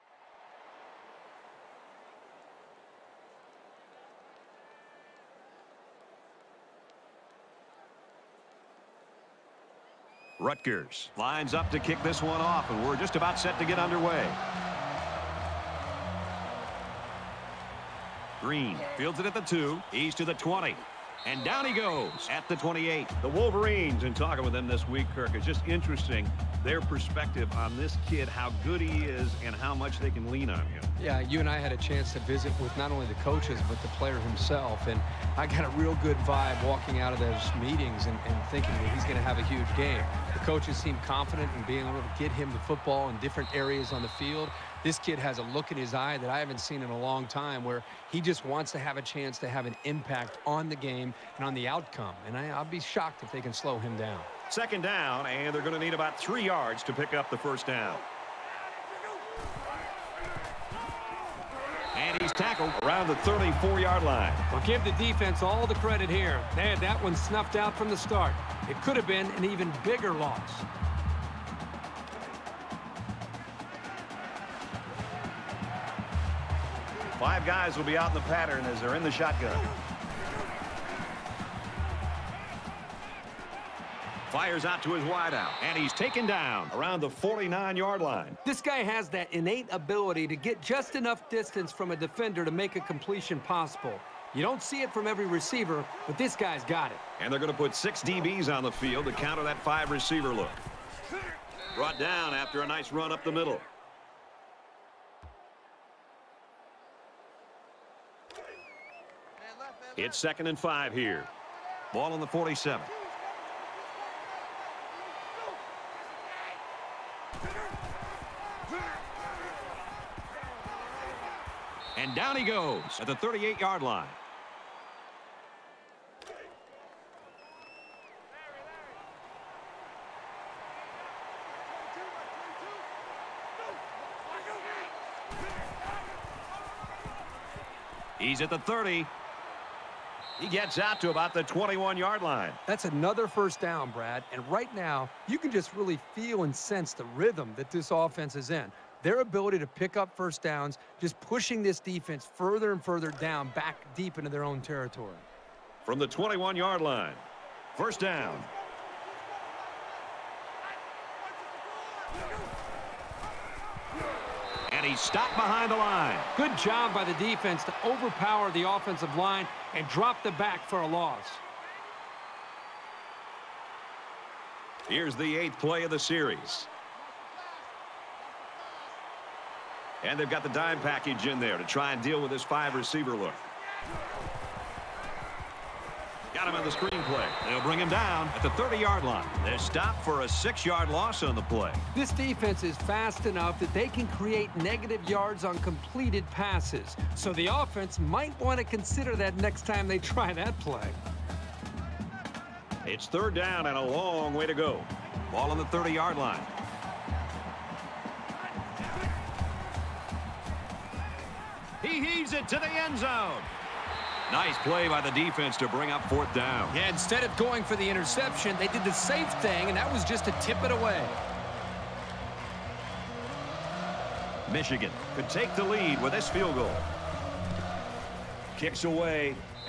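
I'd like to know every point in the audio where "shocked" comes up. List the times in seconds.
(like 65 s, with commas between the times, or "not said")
52 s.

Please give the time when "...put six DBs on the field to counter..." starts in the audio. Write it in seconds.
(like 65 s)
97 s.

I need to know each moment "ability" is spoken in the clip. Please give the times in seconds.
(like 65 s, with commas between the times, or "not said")
89 s, 149 s.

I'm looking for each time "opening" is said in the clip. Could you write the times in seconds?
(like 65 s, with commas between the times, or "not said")
not said.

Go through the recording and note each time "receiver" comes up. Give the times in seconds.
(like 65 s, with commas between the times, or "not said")
95 s, 99 s, 182 s.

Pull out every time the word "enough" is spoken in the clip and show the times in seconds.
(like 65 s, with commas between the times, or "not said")
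90 s, 193 s.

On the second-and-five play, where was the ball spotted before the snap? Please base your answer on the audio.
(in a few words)
47.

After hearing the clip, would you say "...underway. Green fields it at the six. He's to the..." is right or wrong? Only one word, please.
wrong.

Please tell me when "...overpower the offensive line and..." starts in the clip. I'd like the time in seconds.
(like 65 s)
167 s.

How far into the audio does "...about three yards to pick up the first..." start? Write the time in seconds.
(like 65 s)
55 s.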